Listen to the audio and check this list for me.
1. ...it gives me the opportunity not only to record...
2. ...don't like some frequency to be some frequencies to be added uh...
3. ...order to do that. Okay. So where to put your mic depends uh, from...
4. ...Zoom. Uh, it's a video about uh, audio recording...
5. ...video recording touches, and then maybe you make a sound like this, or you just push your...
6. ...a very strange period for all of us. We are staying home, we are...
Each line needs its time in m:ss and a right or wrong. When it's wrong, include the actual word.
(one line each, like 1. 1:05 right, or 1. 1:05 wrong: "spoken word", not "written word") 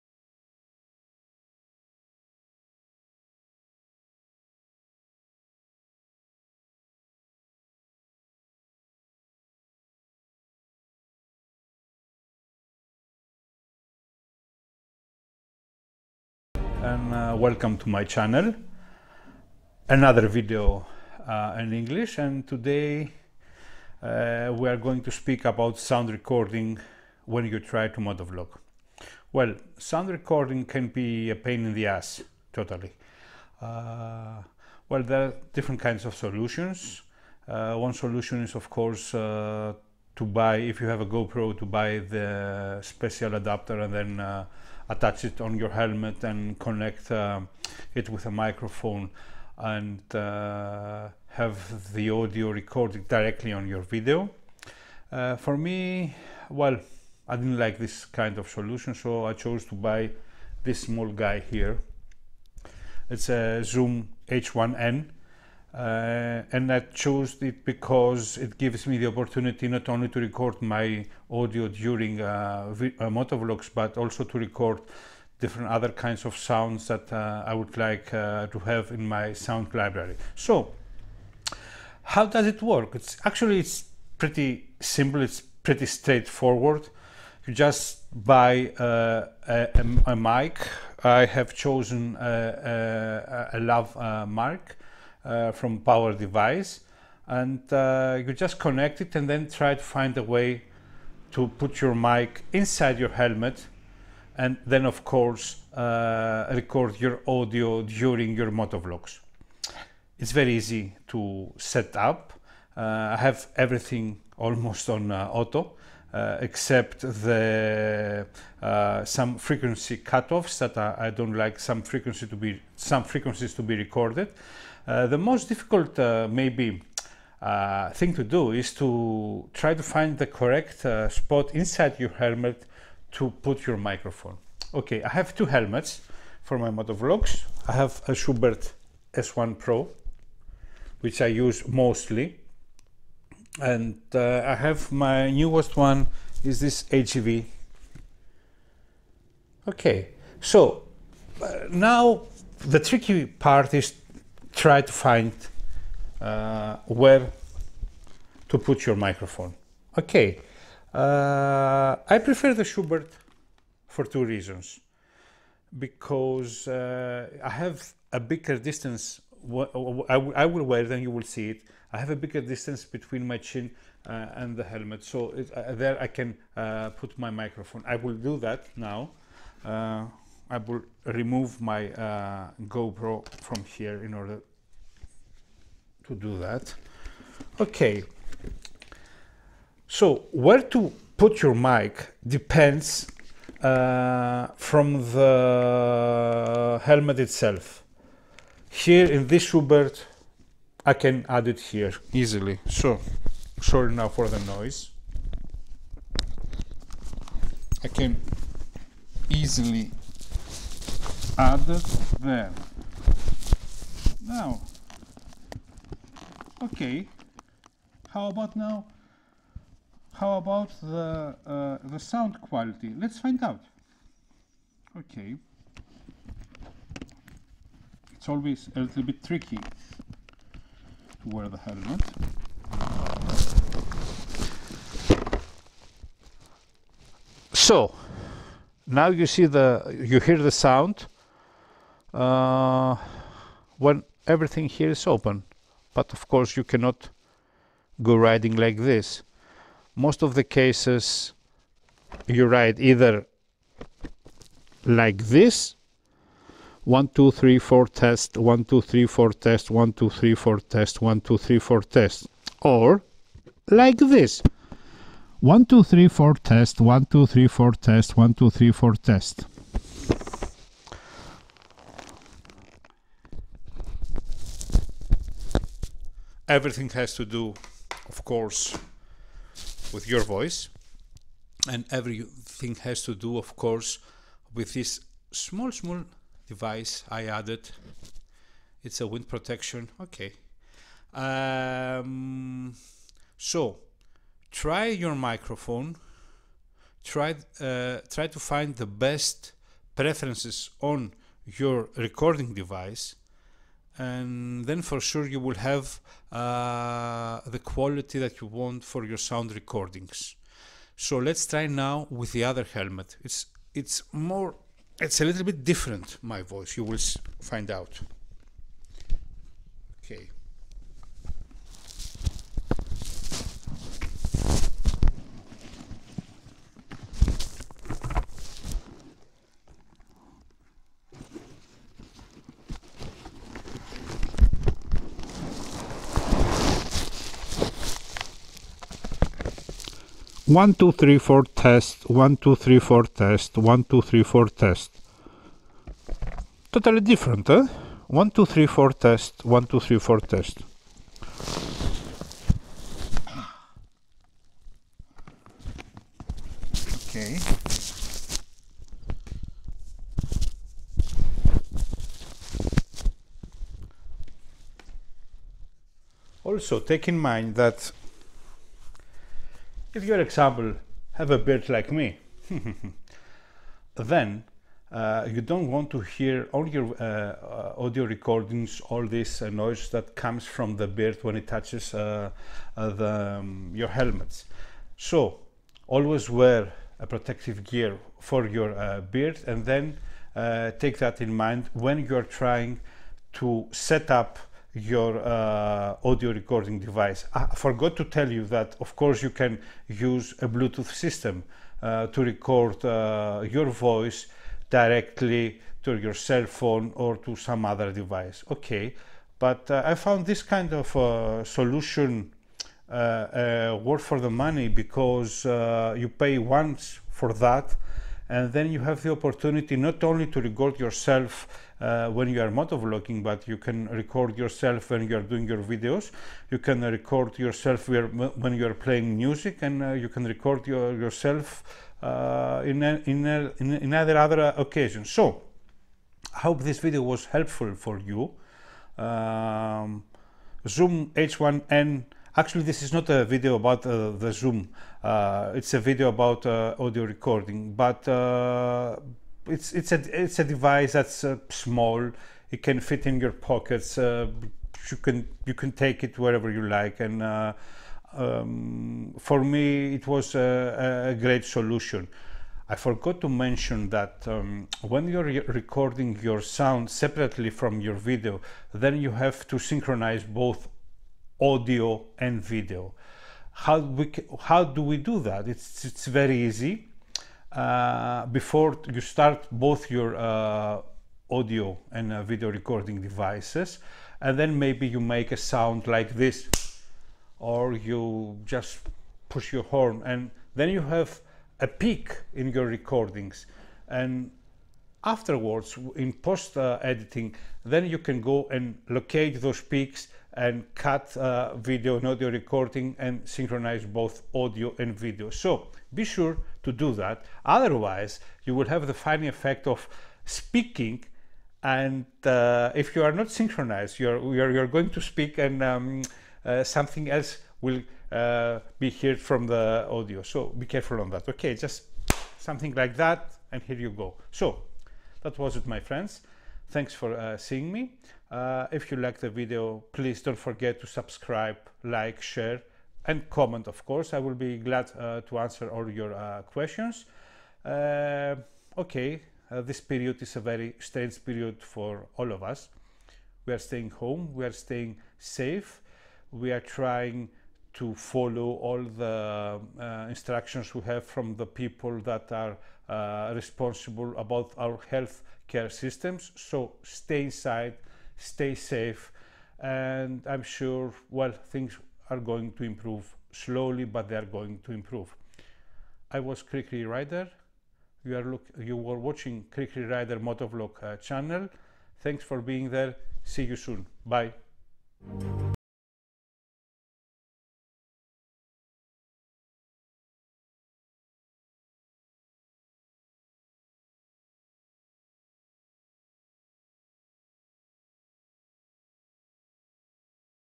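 1. 1:08 right
2. 2:01 wrong: "recorded", not "added"
3. 3:04 right
4. 7:24 right
5. 8:02 wrong: "devices", not "touches"
6. 9:00 right.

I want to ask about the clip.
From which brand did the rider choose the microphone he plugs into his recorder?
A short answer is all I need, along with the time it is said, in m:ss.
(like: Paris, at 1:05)
PowerDeWise, at 1:35.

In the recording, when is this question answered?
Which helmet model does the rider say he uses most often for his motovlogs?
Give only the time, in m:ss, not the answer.
2:18.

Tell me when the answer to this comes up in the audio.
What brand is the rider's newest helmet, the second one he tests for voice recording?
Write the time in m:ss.
2:26.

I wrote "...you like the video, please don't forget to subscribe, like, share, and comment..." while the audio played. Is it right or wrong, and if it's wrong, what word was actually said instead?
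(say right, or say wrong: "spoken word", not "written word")
right.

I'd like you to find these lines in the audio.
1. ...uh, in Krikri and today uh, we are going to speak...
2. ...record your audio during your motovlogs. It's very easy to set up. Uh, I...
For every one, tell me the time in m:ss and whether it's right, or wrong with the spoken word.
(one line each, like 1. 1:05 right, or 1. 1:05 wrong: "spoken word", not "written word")
1. 0:21 wrong: "English", not "Krikri"
2. 1:46 right.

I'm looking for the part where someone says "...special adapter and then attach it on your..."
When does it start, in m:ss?
0:42.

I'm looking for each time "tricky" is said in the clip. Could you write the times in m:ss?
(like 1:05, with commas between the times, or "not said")
2:32, 3:49.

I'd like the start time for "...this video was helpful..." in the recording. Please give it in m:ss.
7:16.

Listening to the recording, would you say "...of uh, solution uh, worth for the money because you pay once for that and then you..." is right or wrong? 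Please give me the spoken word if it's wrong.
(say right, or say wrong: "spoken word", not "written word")
right.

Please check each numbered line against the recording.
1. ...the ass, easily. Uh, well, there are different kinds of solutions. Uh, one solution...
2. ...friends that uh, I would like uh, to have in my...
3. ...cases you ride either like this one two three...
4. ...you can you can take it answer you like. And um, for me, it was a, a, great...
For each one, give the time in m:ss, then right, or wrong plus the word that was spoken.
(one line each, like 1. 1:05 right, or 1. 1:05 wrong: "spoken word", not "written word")
1. 0:31 wrong: "totally", not "easily"
2. 1:16 wrong: "sounds", not "friends"
3. 4:10 right
4. 7:34 wrong: "wherever", not "answer".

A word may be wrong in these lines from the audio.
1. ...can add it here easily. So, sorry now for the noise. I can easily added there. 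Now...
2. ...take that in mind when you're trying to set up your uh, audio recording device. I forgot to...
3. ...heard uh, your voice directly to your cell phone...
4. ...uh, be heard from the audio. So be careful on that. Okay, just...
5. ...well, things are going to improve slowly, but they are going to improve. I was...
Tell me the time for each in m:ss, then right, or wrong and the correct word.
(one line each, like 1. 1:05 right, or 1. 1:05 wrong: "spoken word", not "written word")
1. 3:20 right
2. 6:30 right
3. 6:42 wrong: "record", not "heard"
4. 8:38 right
5. 9:21 right.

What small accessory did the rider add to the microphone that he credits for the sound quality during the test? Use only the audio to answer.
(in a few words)
wind protection.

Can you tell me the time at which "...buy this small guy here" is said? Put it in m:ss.
0:59.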